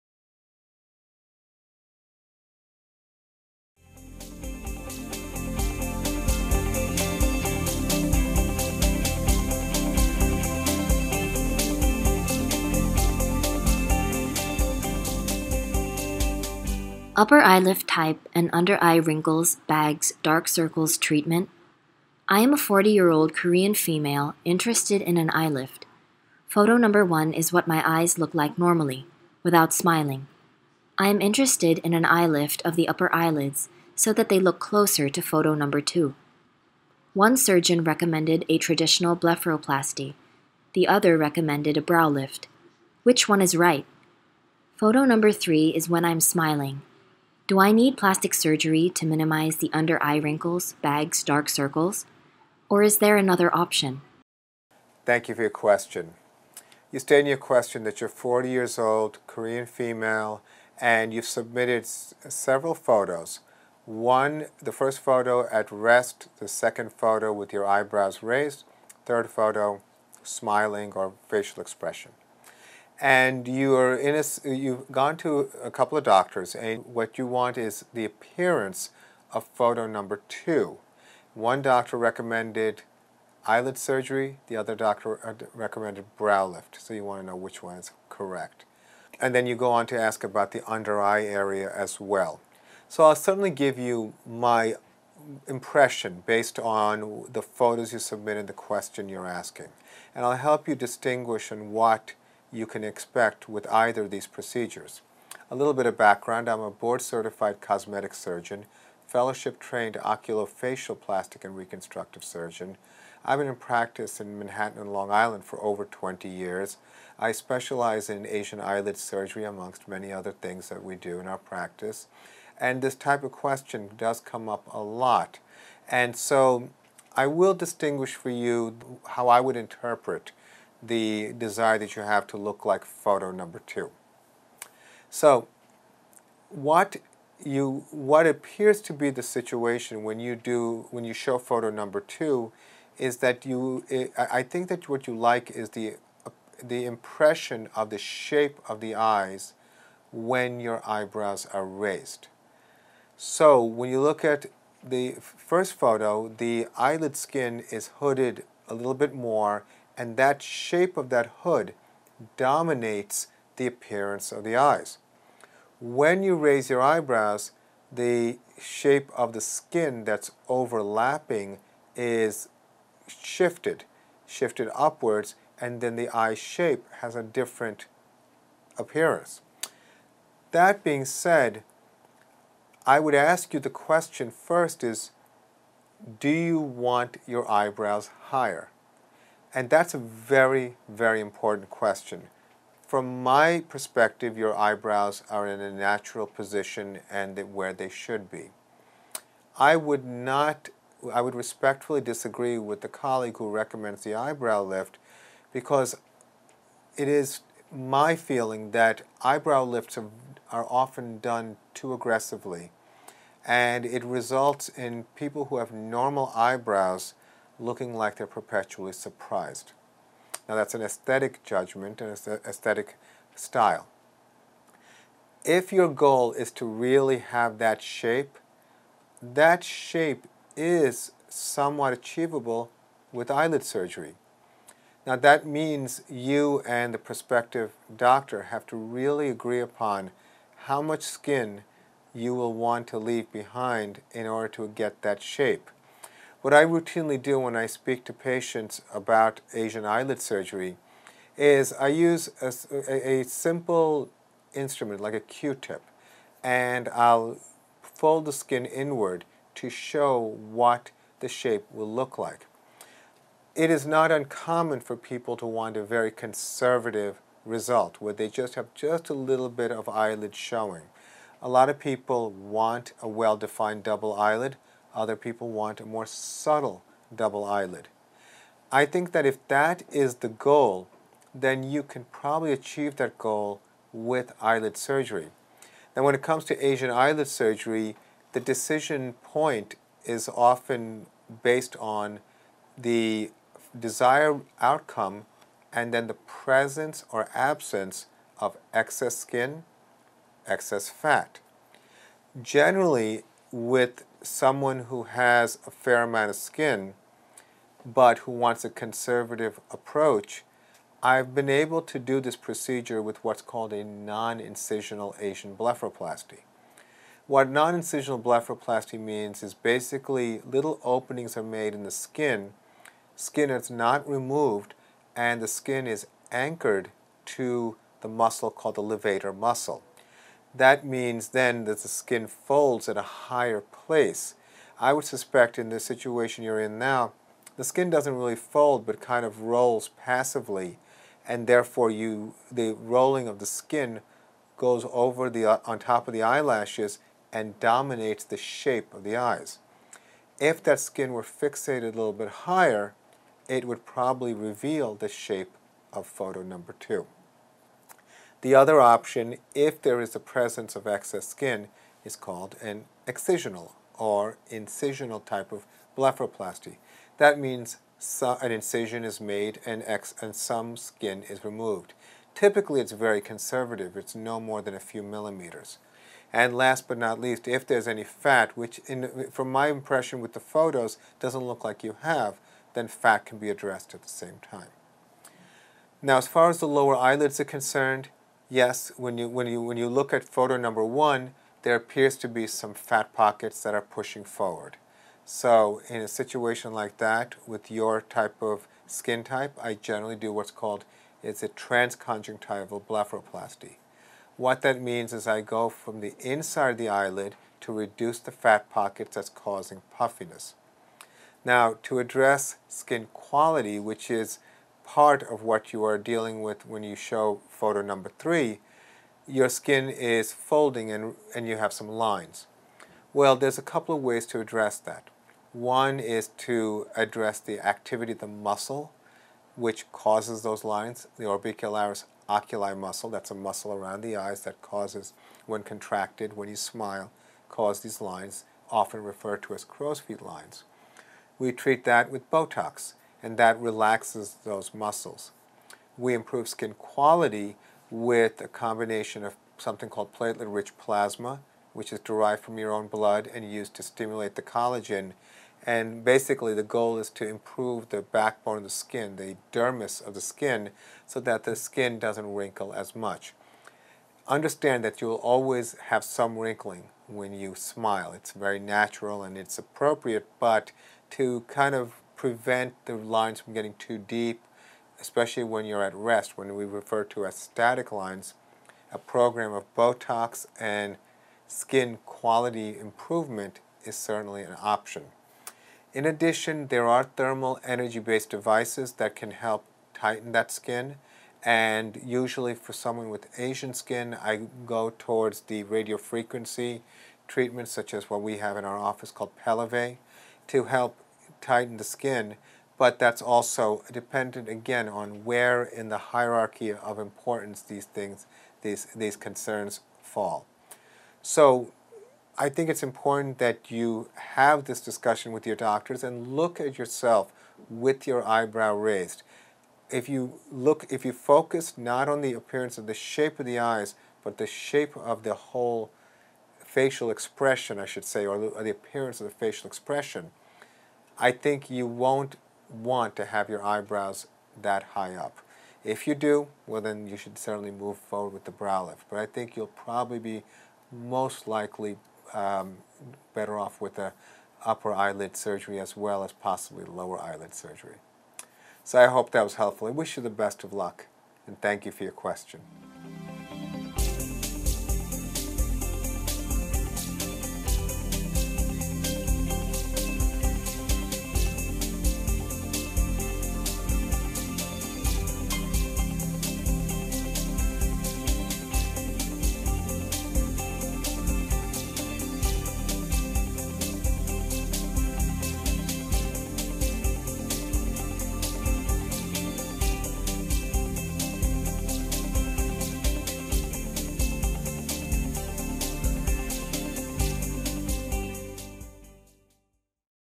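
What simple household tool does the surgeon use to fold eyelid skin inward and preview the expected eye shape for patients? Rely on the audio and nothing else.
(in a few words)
Q-tip.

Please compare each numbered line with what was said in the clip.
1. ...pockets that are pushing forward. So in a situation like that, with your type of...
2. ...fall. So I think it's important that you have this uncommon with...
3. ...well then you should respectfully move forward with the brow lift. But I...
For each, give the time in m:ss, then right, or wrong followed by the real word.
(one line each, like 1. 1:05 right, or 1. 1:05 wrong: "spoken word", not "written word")
1. 6:33 right
2. 8:30 wrong: "discussion", not "uncommon"
3. 8:56 wrong: "certainly", not "respectfully".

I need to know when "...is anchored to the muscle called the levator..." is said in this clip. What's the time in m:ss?
5:25.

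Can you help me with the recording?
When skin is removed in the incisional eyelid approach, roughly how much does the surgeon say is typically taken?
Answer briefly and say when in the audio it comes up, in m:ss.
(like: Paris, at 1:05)
a few millimeters, at 6:14.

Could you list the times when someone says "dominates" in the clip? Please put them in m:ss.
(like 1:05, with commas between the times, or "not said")
2:42, 5:47.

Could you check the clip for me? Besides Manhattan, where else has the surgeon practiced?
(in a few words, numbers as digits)
Long Island.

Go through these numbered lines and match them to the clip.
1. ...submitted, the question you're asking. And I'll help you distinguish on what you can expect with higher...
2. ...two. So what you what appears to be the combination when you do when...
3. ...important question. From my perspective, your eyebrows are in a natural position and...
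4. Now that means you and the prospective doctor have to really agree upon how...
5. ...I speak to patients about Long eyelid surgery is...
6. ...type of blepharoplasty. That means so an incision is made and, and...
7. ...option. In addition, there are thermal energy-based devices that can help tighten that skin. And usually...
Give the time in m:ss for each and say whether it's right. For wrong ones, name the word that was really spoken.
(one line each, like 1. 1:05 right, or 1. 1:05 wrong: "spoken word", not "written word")
1. 1:37 wrong: "either", not "higher"
2. 2:13 wrong: "situation", not "combination"
3. 3:11 right
4. 3:55 right
5. 4:07 wrong: "Asian", not "Long"
6. 6:05 right
7. 8:04 right.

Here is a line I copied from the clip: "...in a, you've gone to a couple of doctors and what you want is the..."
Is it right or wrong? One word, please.
right.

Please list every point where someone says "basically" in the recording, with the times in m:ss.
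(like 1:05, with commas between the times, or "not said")
5:19, 7:36.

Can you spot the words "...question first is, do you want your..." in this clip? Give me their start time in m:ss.
3:03.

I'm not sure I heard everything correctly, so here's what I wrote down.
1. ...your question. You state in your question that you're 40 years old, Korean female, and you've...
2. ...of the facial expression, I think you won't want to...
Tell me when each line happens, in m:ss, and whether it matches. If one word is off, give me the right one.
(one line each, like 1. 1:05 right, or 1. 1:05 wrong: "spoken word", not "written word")
1. 0:55 right
2. 8:49 right.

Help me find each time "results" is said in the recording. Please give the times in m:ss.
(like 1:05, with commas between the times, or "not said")
3:34, 4:27.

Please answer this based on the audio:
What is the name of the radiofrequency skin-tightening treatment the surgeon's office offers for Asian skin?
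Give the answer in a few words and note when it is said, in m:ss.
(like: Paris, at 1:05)
Pellevé, at 8:19.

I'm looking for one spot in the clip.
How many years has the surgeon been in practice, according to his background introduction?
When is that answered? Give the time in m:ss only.
1:55.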